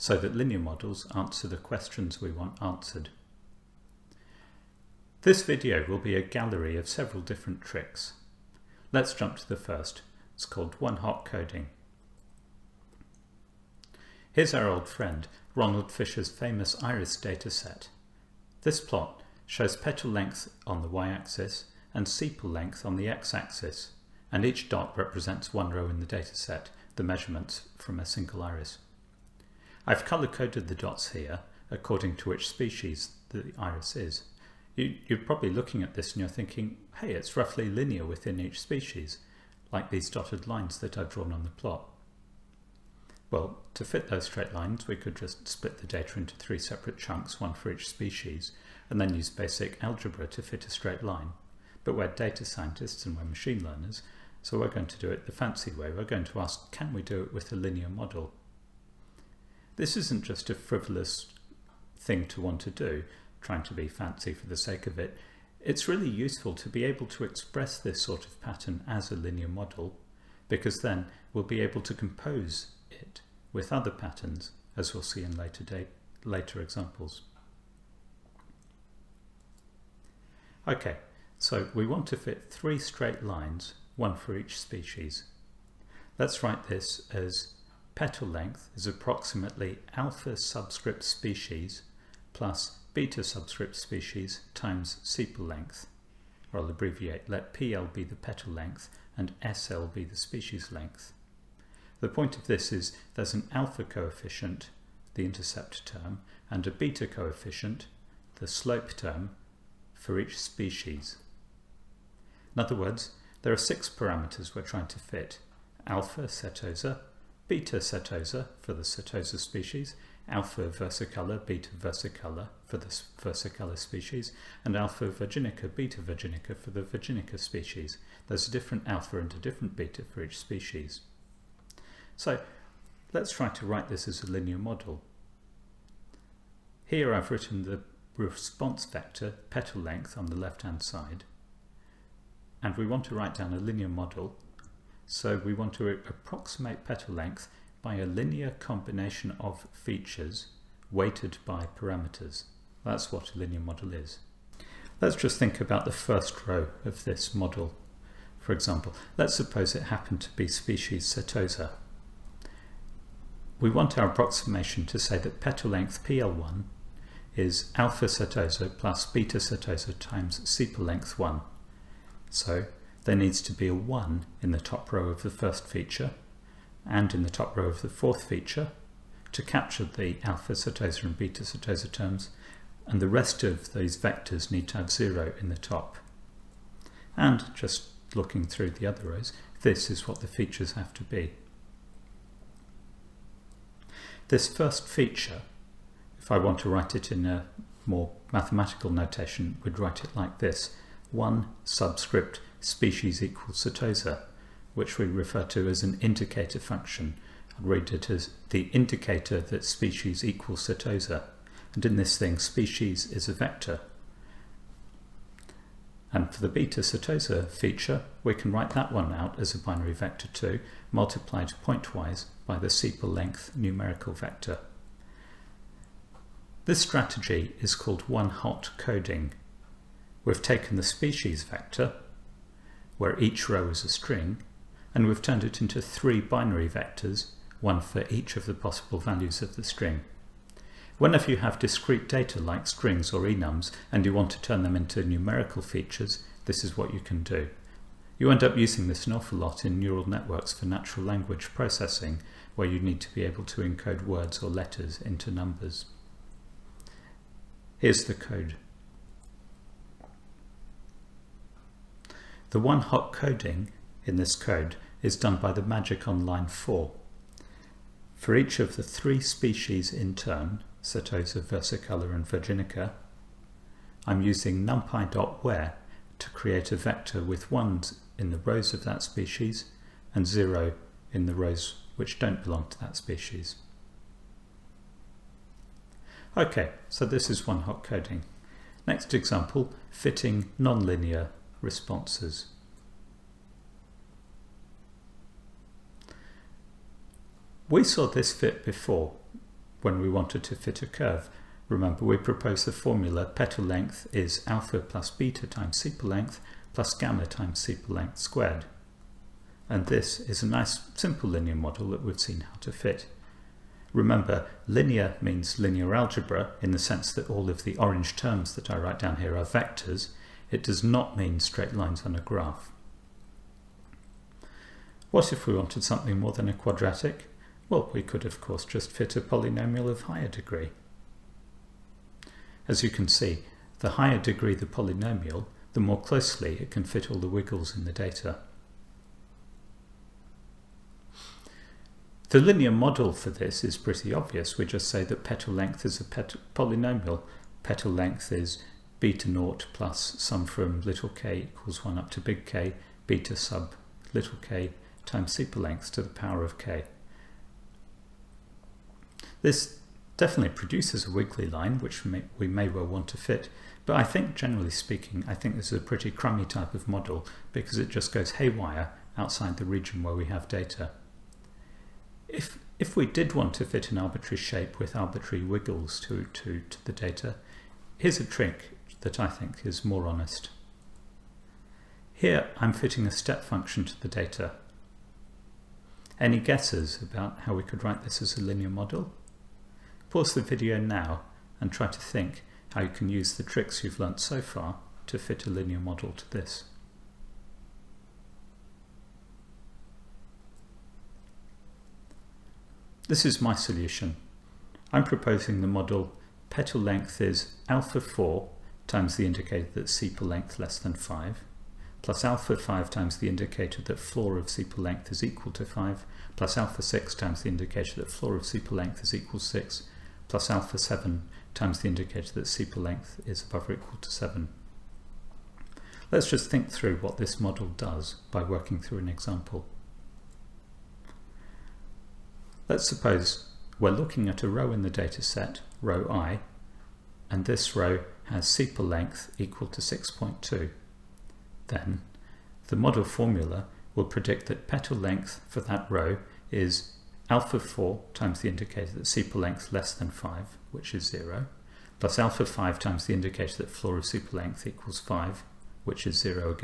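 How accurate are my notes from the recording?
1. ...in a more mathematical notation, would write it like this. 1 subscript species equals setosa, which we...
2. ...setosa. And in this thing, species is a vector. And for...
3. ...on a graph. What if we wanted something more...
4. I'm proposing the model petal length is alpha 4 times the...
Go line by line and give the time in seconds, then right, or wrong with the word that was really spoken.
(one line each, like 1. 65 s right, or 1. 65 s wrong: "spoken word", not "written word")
1. 197 s right
2. 210 s right
3. 322 s right
4. 404 s right.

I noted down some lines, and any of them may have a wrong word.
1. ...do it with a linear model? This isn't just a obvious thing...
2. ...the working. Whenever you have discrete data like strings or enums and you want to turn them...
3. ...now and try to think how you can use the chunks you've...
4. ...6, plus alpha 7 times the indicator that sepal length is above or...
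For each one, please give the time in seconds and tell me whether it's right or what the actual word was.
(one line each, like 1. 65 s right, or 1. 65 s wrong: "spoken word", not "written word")
1. 57 s wrong: "frivolous", not "obvious"
2. 239 s wrong: "string", not "working"
3. 390 s wrong: "tricks", not "chunks"
4. 419 s right.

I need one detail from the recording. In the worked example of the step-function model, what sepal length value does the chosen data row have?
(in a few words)
6.2.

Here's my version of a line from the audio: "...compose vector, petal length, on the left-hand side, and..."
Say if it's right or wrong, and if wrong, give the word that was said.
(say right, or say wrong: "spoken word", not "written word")
wrong: "response", not "compose".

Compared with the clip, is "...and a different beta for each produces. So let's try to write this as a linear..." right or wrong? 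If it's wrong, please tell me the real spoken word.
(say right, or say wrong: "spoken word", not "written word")
wrong: "species", not "produces".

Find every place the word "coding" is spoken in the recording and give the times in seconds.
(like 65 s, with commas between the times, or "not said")
11 s, 228 s, 263 s, 287 s.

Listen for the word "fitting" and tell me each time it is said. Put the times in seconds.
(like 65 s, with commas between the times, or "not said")
289 s, 382 s.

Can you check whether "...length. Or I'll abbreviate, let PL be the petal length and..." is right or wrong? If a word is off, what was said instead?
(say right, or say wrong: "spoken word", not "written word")
right.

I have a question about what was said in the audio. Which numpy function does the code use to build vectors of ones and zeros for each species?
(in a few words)
numpy.where.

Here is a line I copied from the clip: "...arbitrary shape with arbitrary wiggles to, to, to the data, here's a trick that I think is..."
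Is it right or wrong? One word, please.
right.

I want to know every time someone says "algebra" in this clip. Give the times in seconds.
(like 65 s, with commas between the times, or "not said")
49 s, 315 s.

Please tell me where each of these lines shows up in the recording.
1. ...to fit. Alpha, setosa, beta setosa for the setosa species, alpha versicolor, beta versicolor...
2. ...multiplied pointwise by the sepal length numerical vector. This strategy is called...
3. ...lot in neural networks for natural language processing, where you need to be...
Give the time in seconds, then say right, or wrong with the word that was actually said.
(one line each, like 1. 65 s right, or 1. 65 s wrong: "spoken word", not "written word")
1. 114 s right
2. 220 s right
3. 249 s right.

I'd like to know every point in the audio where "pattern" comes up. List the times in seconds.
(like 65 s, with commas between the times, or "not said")
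68 s, 73 s.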